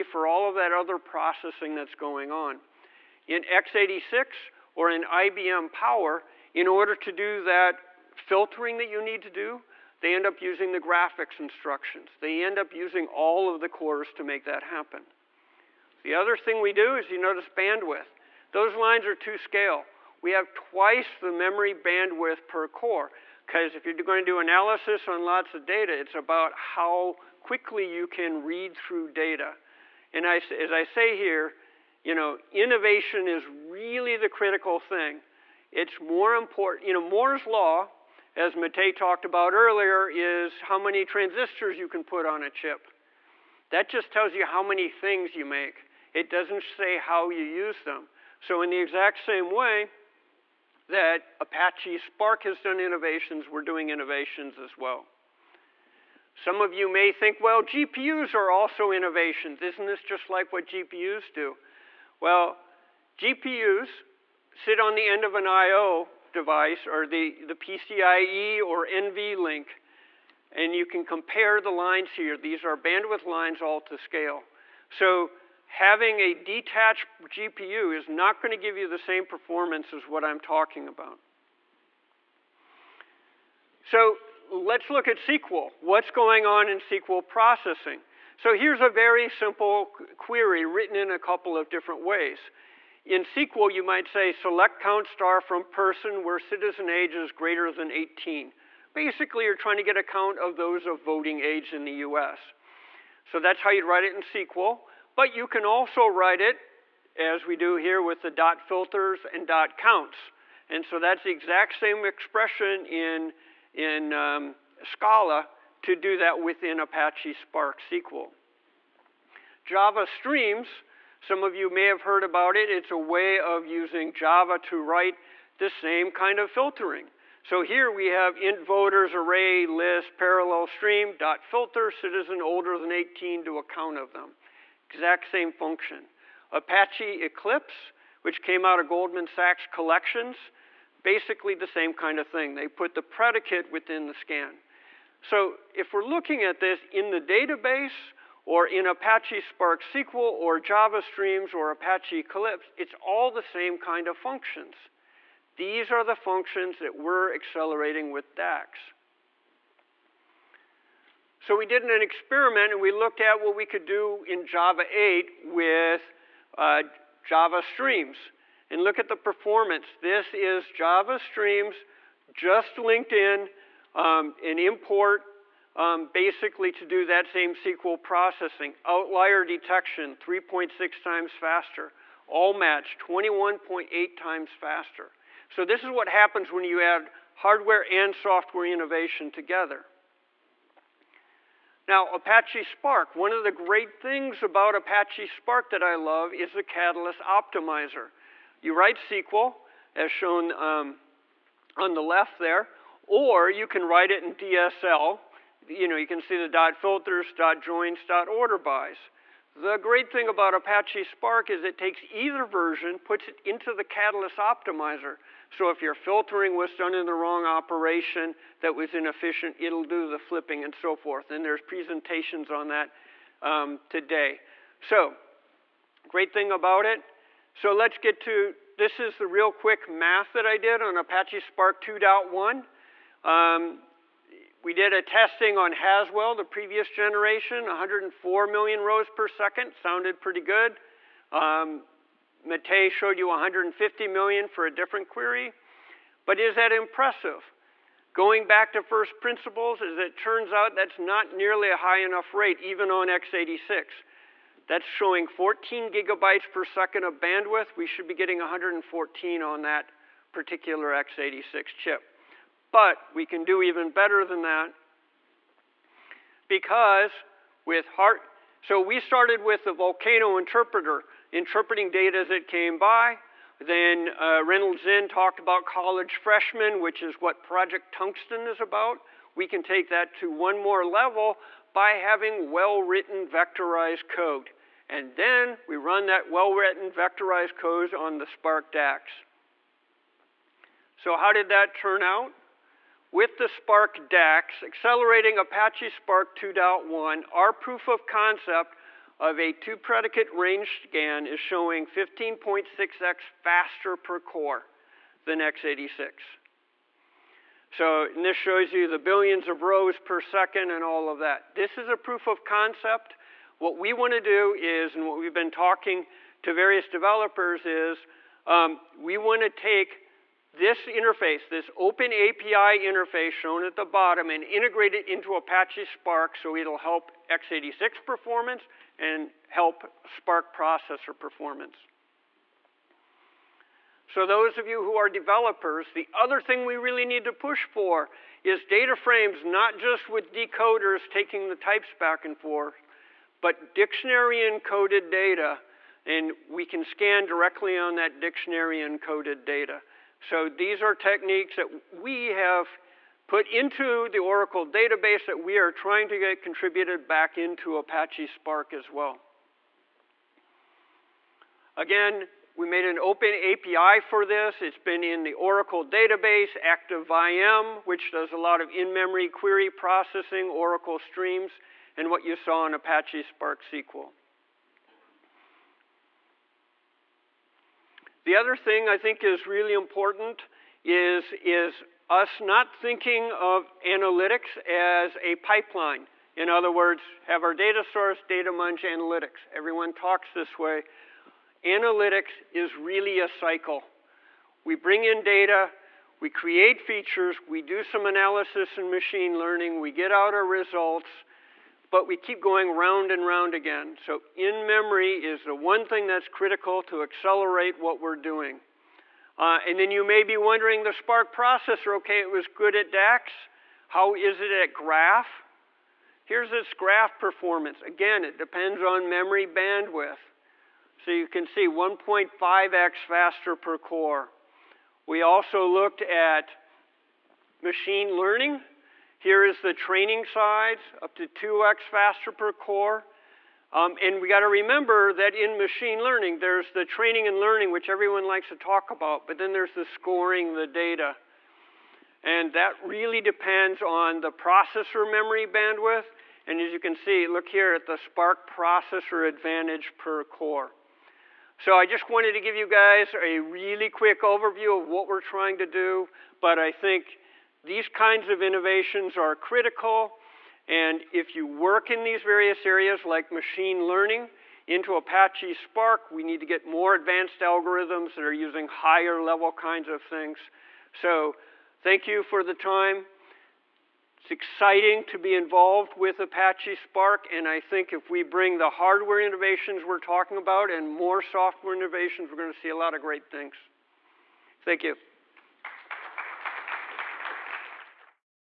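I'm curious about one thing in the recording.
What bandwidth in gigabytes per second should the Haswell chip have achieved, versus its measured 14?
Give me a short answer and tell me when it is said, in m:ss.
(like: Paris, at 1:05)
114, at 4:18.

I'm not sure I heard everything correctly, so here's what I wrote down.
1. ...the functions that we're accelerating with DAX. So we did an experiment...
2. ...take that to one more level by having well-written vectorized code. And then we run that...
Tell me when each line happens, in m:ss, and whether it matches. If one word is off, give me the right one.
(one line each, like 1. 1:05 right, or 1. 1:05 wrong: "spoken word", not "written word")
1. 2:36 right
2. 4:39 right.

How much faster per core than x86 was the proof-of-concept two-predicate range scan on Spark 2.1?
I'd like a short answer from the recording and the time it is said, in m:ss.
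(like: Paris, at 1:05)
15.6x, at 5:01.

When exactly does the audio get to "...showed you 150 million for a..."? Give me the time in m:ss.
4:02.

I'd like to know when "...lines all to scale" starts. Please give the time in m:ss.
1:13.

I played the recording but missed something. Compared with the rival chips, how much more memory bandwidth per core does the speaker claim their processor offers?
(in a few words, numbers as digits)
twice.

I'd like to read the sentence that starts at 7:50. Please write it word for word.
So thank you for the time.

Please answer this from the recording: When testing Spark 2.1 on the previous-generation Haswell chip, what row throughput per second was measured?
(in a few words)
104 million.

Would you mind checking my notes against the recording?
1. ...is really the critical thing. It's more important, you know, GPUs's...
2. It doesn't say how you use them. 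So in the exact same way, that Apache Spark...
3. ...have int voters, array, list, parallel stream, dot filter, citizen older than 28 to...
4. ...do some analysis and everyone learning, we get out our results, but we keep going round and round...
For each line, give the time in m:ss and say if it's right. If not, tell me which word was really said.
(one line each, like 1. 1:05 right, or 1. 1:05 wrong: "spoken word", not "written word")
1. 0:33 wrong: "Moore", not "GPUs"
2. 0:46 right
3. 2:08 wrong: "18", not "28"
4. 6:37 wrong: "machine", not "everyone".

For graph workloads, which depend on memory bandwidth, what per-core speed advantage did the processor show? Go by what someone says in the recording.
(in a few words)
1.5x.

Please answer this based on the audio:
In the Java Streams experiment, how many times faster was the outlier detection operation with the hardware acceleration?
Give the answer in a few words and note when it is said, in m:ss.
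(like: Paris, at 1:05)
3.6 times, at 3:00.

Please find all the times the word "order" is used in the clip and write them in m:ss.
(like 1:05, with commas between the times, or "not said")
0:06, 3:28.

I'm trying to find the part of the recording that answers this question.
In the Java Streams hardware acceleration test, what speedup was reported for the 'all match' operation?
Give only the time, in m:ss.
3:02.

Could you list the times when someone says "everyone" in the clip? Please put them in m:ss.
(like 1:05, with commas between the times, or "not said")
6:29, 7:17.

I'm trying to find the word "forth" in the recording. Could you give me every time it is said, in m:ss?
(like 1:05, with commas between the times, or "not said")
3:40, 5:42.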